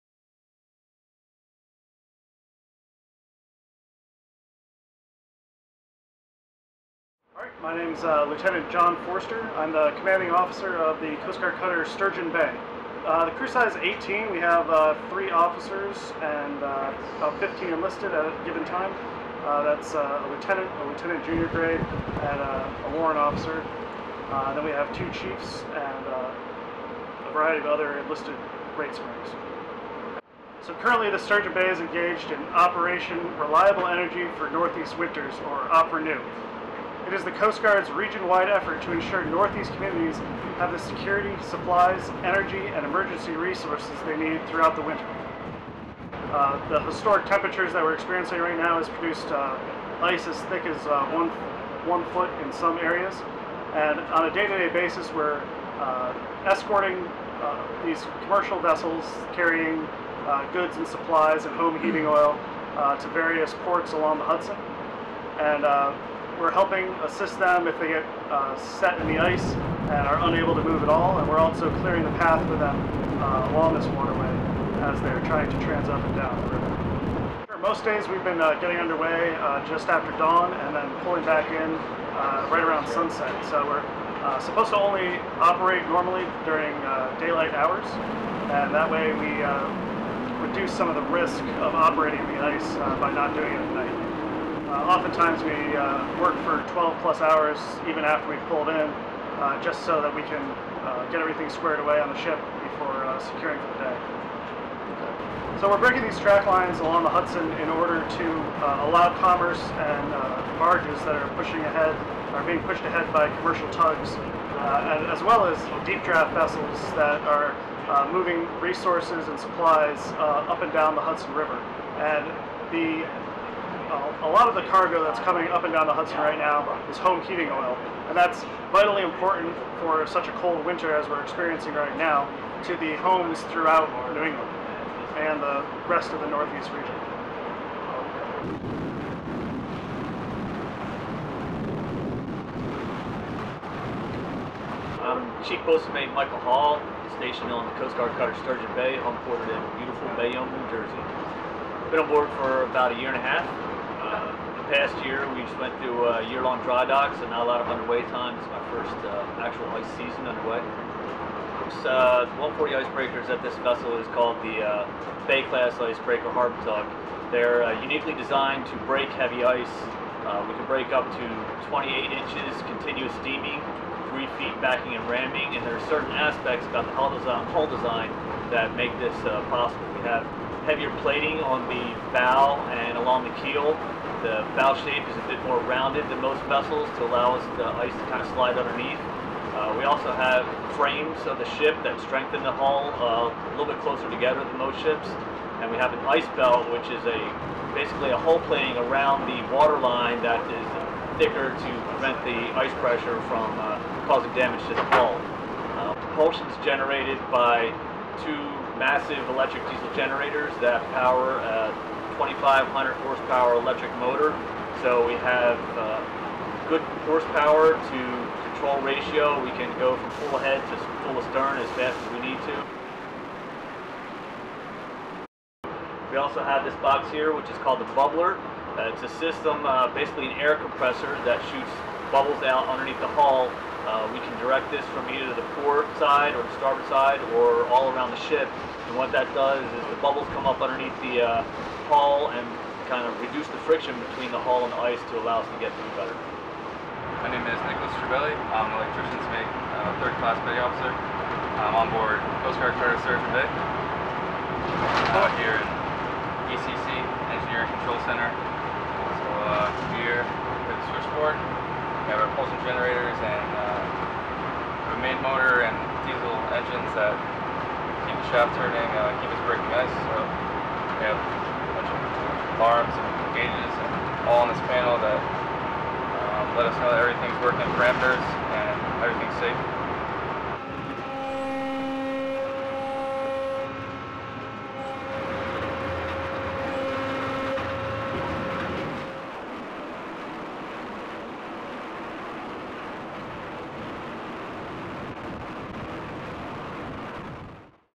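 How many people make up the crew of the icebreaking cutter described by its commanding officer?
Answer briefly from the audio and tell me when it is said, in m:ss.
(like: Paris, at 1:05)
18, at 0:13.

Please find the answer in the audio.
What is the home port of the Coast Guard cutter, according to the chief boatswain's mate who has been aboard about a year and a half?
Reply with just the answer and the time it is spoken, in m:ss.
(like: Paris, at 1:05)
Bayonne, New Jersey, at 2:30.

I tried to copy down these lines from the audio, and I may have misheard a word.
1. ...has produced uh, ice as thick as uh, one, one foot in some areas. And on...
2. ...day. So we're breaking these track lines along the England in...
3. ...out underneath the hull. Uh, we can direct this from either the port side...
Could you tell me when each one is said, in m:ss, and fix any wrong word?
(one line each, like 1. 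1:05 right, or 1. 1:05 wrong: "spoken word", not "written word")
1. 0:48 right
2. 1:43 wrong: "Hudson", not "England"
3. 3:52 right.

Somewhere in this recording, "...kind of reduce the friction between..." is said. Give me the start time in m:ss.
4:02.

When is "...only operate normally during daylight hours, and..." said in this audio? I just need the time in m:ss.
1:24.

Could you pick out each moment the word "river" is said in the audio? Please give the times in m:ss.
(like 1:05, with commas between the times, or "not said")
1:16, 2:01.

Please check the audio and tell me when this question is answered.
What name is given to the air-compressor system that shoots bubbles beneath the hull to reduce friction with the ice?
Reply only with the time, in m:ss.
3:47.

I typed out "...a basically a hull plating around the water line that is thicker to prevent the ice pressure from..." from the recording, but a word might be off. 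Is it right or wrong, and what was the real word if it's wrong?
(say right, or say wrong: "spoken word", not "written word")
right.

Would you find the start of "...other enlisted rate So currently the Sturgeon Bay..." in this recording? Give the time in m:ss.
0:27.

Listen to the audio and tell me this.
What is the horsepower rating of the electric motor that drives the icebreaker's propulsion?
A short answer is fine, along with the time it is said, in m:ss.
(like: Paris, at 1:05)
2,500, at 3:32.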